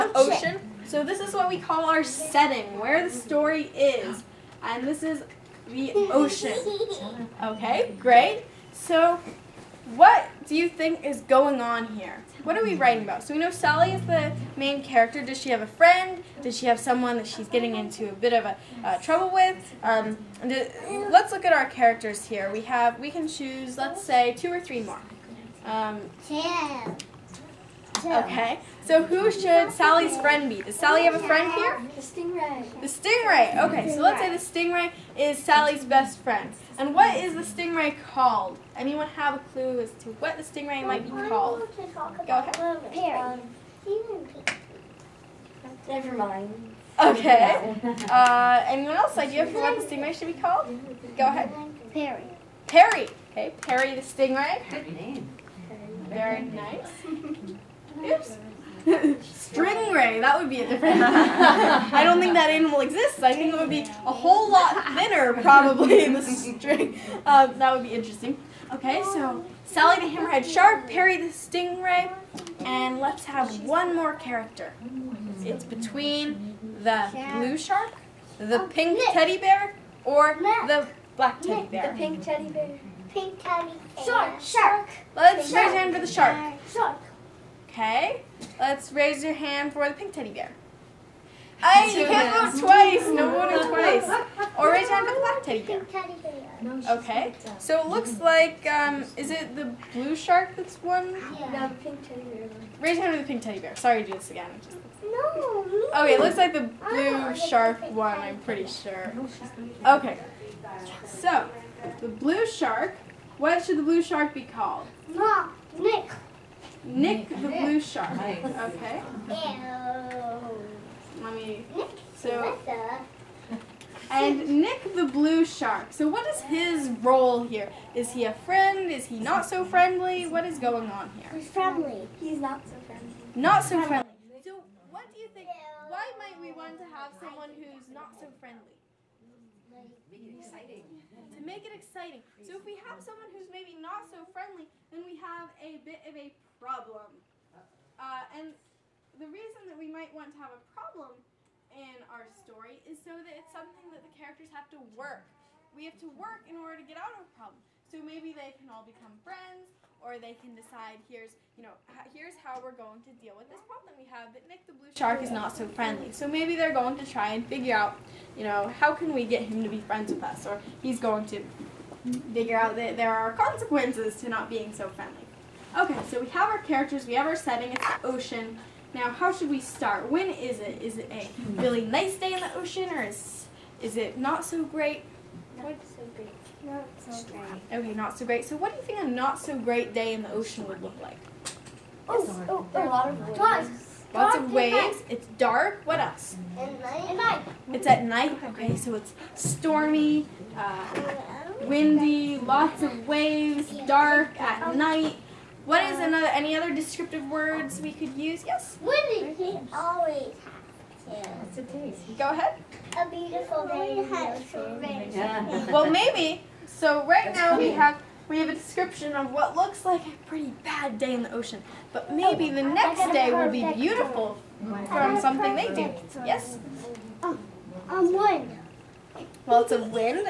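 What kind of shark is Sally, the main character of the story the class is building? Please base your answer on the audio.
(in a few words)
Hammerhead.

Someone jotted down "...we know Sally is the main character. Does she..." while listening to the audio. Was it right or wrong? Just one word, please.
right.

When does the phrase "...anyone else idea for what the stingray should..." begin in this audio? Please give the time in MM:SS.
00:48.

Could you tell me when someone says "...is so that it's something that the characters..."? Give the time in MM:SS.
02:32.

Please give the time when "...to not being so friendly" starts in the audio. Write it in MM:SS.
02:54.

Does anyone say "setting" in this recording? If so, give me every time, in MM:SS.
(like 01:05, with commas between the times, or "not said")
00:02, 02:57.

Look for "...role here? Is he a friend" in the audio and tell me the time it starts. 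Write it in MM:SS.
02:07.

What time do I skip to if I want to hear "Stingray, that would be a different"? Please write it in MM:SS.
00:58.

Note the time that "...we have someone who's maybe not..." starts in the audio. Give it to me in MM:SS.
02:22.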